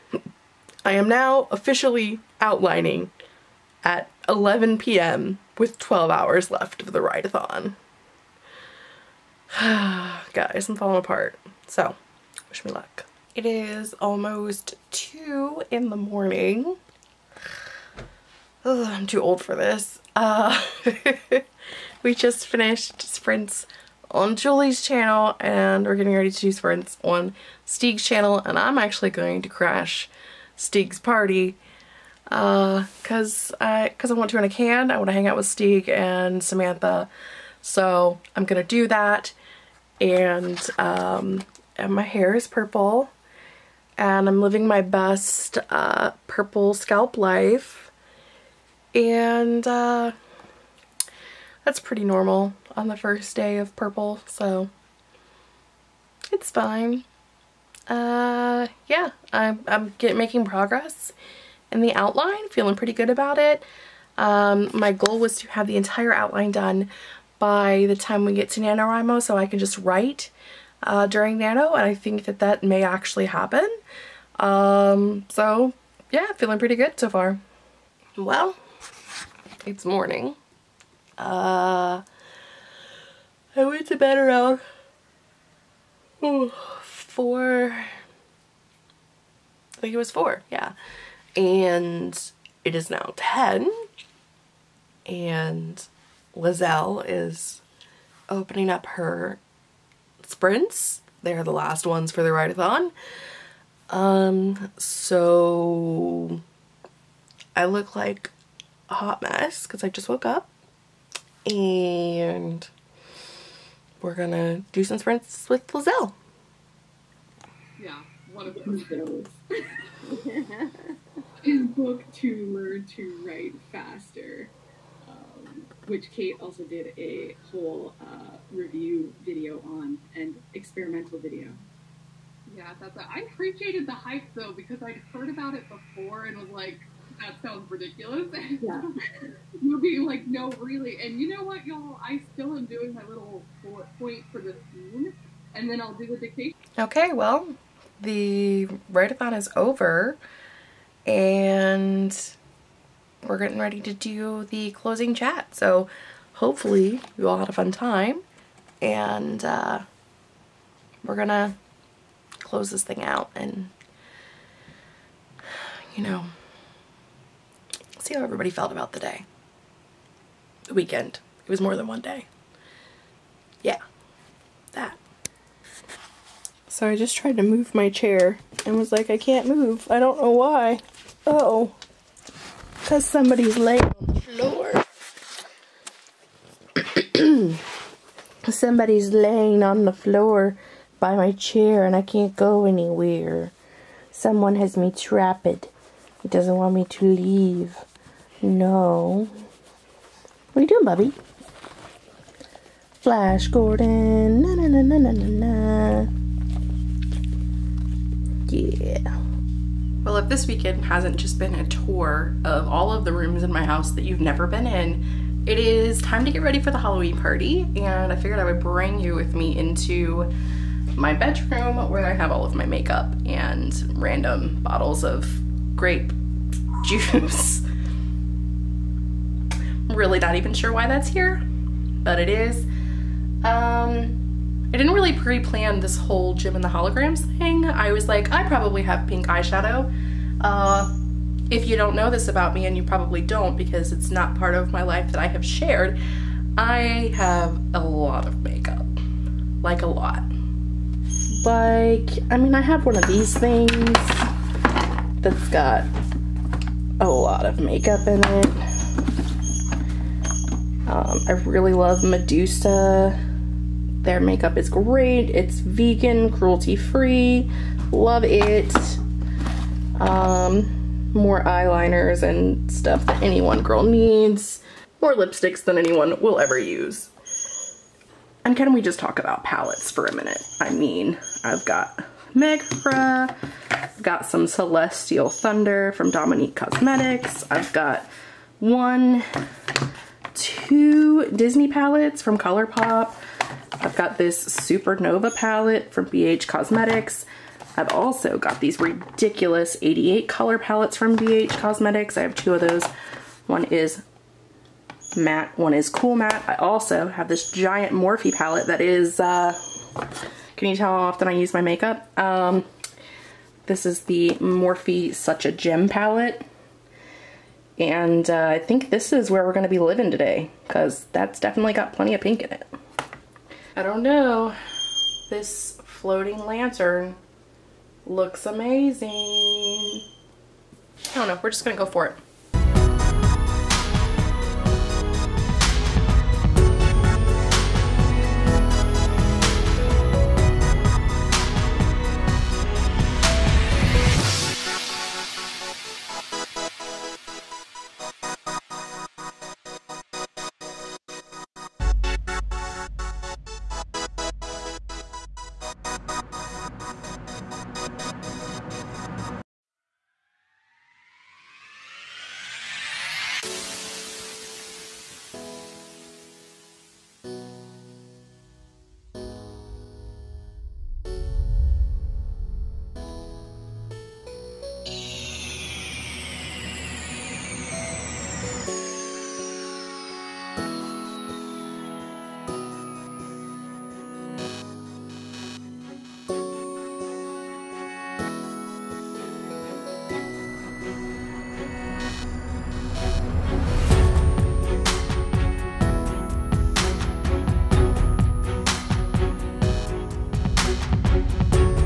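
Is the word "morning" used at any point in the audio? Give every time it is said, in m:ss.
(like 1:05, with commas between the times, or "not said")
0:15, 1:19.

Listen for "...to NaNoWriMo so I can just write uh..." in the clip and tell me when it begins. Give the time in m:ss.
1:08.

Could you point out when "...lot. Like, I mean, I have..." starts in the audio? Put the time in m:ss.
4:09.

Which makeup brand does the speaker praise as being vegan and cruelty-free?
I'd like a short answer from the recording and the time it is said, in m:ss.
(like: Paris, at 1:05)
Medusa, at 4:22.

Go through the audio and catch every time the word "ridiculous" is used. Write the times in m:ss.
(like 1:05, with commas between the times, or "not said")
2:17, 4:58.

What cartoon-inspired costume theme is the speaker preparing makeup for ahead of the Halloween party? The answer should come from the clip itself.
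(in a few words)
Jem and the Holograms.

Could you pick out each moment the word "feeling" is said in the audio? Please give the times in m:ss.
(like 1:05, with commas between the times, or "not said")
1:02, 1:16.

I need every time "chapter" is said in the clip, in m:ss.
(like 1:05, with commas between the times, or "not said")
not said.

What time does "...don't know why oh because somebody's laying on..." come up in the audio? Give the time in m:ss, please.
2:59.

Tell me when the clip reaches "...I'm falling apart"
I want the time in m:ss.
0:10.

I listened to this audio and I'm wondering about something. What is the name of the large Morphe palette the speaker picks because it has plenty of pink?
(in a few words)
Such a Gem.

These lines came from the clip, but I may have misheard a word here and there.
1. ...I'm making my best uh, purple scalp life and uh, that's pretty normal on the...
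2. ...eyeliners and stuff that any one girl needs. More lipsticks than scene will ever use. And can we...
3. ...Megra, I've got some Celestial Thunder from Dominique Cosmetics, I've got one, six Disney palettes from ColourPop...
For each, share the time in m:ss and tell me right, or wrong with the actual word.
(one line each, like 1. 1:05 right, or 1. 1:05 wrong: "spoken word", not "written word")
1. 0:44 wrong: "living", not "making"
2. 4:31 wrong: "anyone", not "scene"
3. 4:42 wrong: "two", not "six".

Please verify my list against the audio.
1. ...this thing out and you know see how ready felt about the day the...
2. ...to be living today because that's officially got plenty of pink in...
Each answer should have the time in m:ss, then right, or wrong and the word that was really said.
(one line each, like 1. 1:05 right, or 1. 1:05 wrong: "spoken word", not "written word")
1. 2:42 wrong: "everybody", not "ready"
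2. 5:19 wrong: "definitely", not "officially".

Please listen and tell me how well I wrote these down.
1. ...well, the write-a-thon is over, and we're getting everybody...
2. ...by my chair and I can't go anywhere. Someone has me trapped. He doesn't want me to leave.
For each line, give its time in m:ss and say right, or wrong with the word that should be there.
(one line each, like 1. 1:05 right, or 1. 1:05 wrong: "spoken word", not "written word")
1. 2:27 wrong: "ready", not "everybody"
2. 3:10 right.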